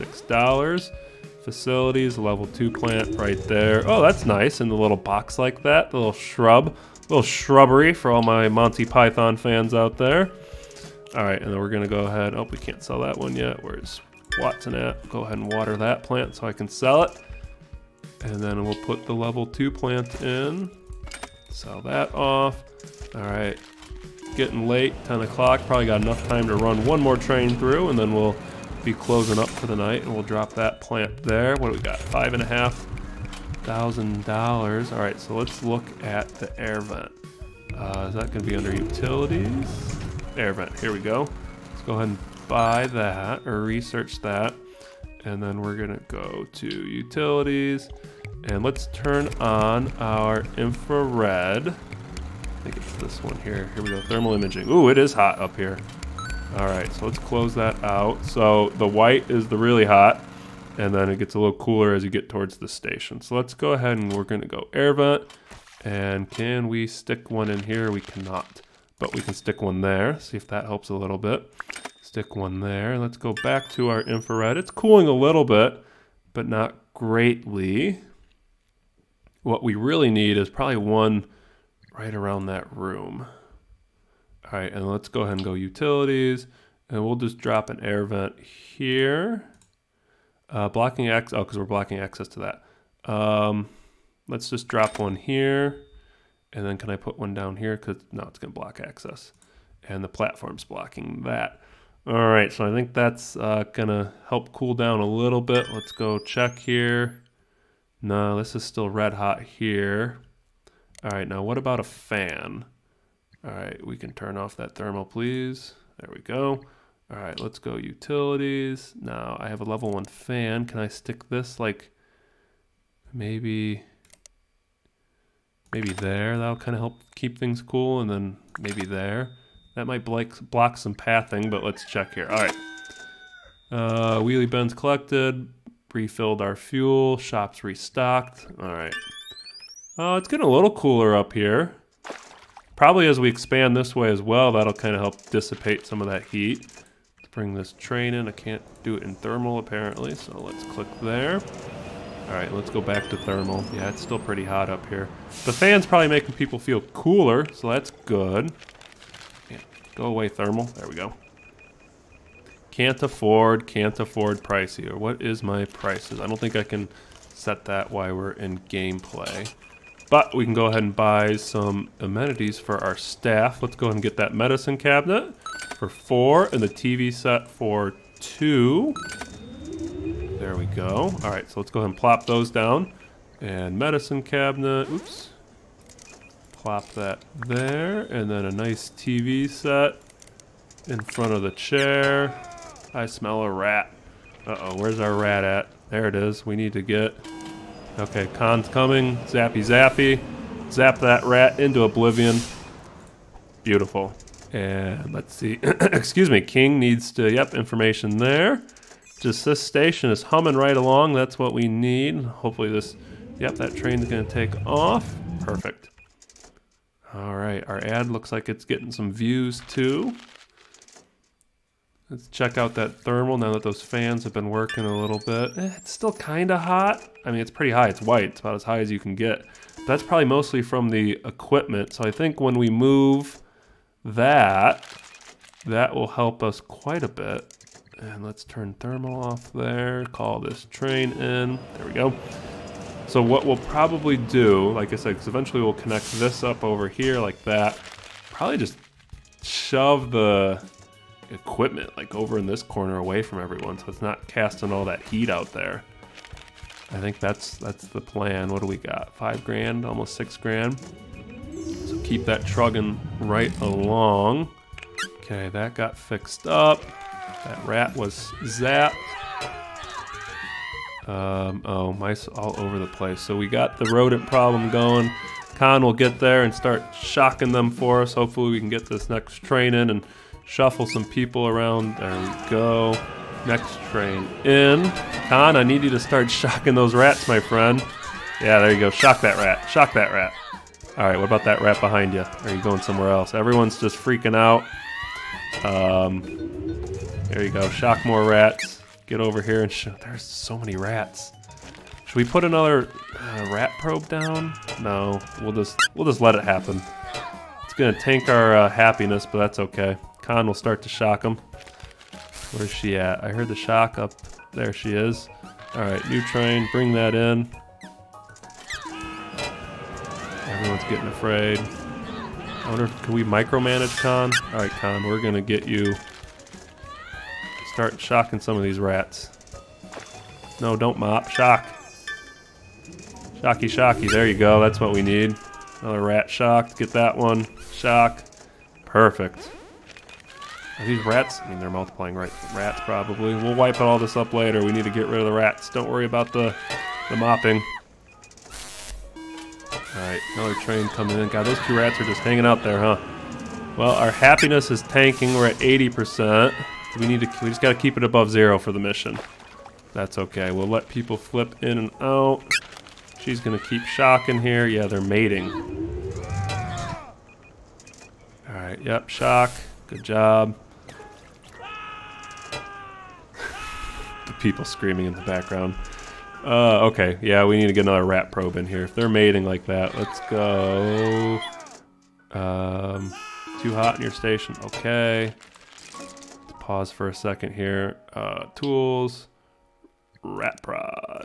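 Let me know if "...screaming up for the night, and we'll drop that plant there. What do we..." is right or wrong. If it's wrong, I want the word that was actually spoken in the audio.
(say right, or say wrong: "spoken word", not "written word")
wrong: "closing", not "screaming".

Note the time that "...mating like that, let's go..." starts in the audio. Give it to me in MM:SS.
06:19.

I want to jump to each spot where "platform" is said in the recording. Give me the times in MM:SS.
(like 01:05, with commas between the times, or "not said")
01:40.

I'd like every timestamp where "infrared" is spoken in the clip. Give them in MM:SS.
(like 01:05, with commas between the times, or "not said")
00:50, 01:14.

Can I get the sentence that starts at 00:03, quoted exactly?
Oh, that's nice in the little box like that, the little shrub.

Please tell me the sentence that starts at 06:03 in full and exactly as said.
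She's going to keep shocking here.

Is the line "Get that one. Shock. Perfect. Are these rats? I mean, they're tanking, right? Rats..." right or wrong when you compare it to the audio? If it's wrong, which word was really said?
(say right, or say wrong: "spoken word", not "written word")
wrong: "multiplying", not "tanking".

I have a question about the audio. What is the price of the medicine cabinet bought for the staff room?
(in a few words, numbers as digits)
4.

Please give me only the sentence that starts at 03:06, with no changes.
Plop that there, and then a nice TV set in front of the chair.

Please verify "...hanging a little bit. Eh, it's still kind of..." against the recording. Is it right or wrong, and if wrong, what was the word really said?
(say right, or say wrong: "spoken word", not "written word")
wrong: "working", not "hanging".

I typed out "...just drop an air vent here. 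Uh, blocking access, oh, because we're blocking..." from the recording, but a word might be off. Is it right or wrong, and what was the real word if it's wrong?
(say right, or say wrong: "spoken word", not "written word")
right.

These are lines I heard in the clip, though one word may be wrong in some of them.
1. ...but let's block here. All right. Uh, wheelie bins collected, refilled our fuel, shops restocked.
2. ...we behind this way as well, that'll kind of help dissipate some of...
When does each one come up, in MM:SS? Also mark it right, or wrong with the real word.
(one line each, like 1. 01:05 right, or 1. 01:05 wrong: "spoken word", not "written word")
1. 02:11 wrong: "check", not "block"
2. 02:23 wrong: "expand", not "behind".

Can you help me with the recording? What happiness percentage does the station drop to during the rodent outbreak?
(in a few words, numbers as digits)
80%.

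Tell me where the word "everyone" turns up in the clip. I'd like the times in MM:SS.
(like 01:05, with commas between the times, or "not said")
04:13, 04:53, 05:20.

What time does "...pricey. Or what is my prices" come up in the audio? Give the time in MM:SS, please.
02:44.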